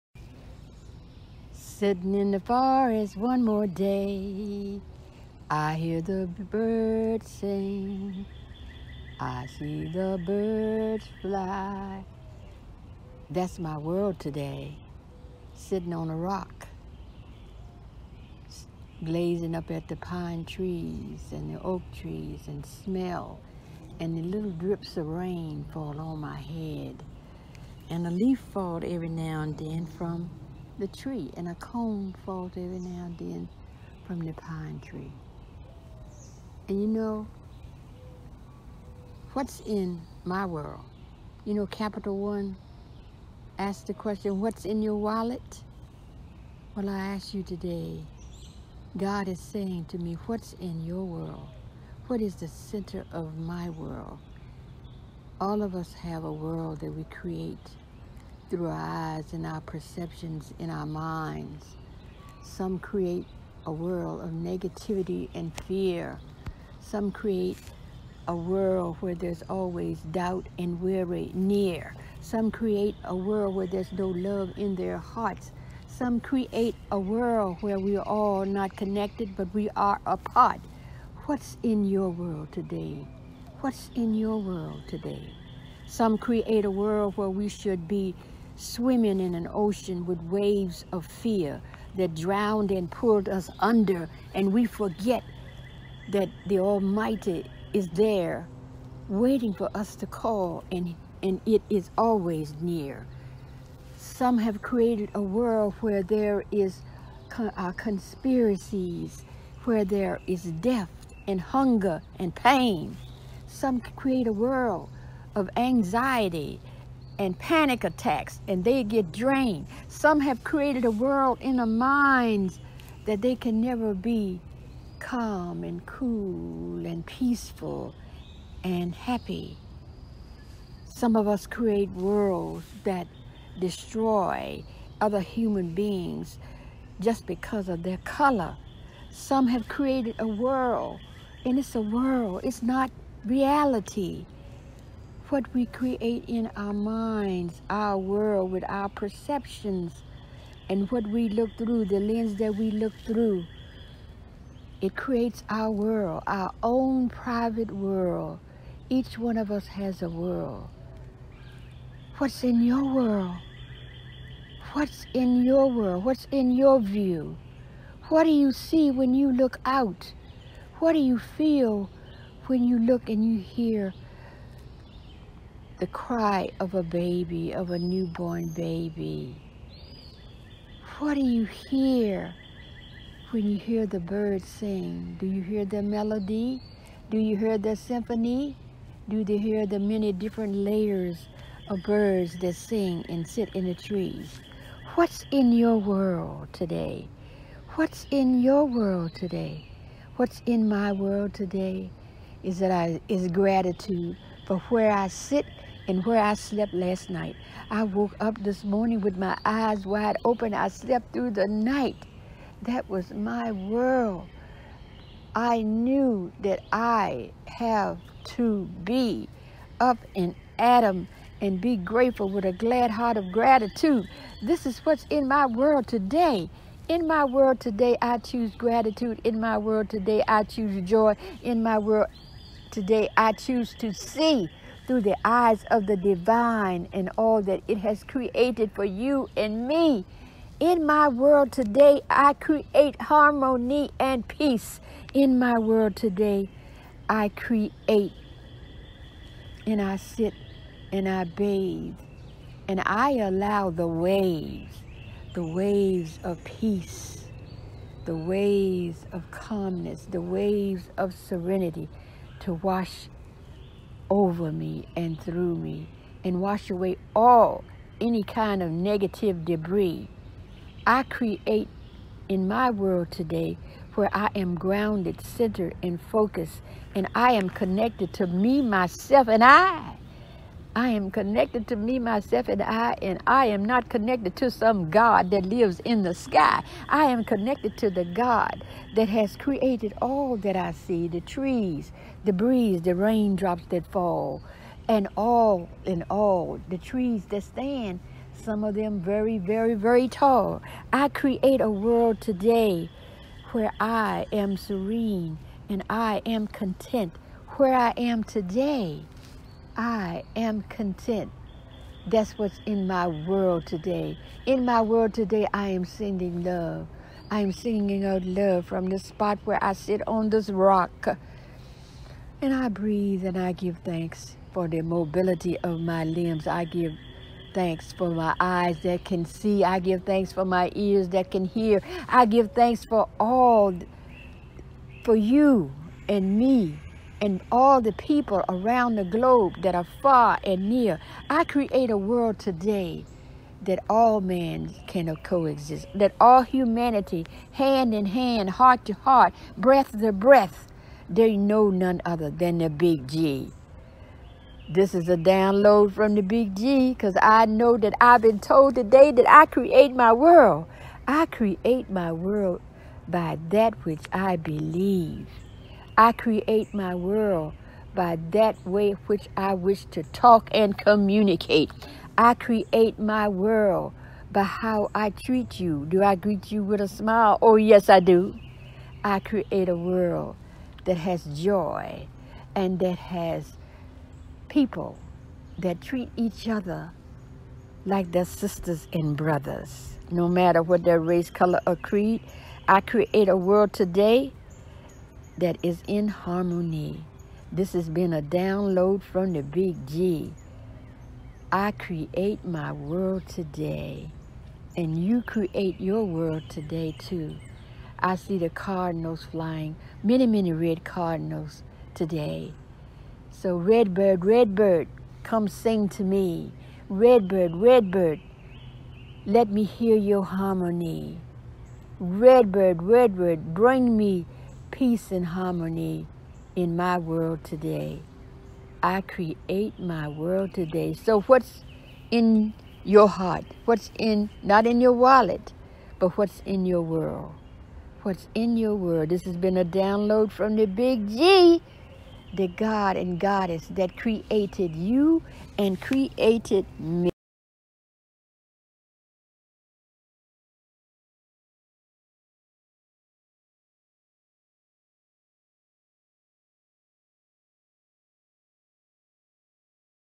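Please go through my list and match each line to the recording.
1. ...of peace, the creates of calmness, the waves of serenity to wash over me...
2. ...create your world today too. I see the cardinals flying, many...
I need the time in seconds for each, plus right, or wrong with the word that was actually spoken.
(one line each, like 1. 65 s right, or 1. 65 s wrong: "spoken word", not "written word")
1. 256 s wrong: "waves", not "creates"
2. 405 s right.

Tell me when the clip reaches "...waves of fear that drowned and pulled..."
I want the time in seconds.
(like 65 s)
90 s.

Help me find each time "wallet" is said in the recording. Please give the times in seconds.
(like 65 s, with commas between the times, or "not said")
44 s, 434 s.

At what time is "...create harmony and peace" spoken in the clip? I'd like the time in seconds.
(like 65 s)
242 s.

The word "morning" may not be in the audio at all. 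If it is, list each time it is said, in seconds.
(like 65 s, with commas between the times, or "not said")
208 s.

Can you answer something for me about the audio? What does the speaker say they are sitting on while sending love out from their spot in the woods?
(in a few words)
a rock.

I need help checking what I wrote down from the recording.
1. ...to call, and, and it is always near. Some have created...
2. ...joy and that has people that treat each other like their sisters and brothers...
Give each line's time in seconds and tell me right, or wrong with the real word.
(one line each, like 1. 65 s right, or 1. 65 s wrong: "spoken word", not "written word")
1. 99 s right
2. 381 s right.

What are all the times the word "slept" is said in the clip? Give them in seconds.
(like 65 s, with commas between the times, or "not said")
206 s, 210 s.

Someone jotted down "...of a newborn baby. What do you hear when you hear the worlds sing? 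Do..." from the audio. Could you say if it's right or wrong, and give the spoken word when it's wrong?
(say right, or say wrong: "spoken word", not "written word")
wrong: "birds", not "worlds".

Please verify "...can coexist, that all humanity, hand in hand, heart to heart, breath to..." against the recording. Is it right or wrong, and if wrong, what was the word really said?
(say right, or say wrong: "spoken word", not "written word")
right.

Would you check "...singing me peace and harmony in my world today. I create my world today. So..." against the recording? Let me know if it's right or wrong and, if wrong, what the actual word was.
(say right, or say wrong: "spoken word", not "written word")
wrong: "bring", not "singing".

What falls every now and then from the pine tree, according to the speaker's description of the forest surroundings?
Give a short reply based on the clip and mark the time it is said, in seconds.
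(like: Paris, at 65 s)
a cone, at 31 s.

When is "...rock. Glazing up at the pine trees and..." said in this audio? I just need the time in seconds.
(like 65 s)
16 s.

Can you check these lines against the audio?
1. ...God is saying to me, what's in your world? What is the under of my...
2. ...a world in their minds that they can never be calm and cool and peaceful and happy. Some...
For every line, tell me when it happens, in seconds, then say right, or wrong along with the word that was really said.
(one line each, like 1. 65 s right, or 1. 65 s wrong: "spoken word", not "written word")
1. 48 s wrong: "center", not "under"
2. 120 s right.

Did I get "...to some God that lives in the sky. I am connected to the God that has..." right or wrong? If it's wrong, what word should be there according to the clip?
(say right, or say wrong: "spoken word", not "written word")
right.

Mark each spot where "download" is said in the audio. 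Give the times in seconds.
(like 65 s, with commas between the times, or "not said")
355 s, 398 s, 439 s.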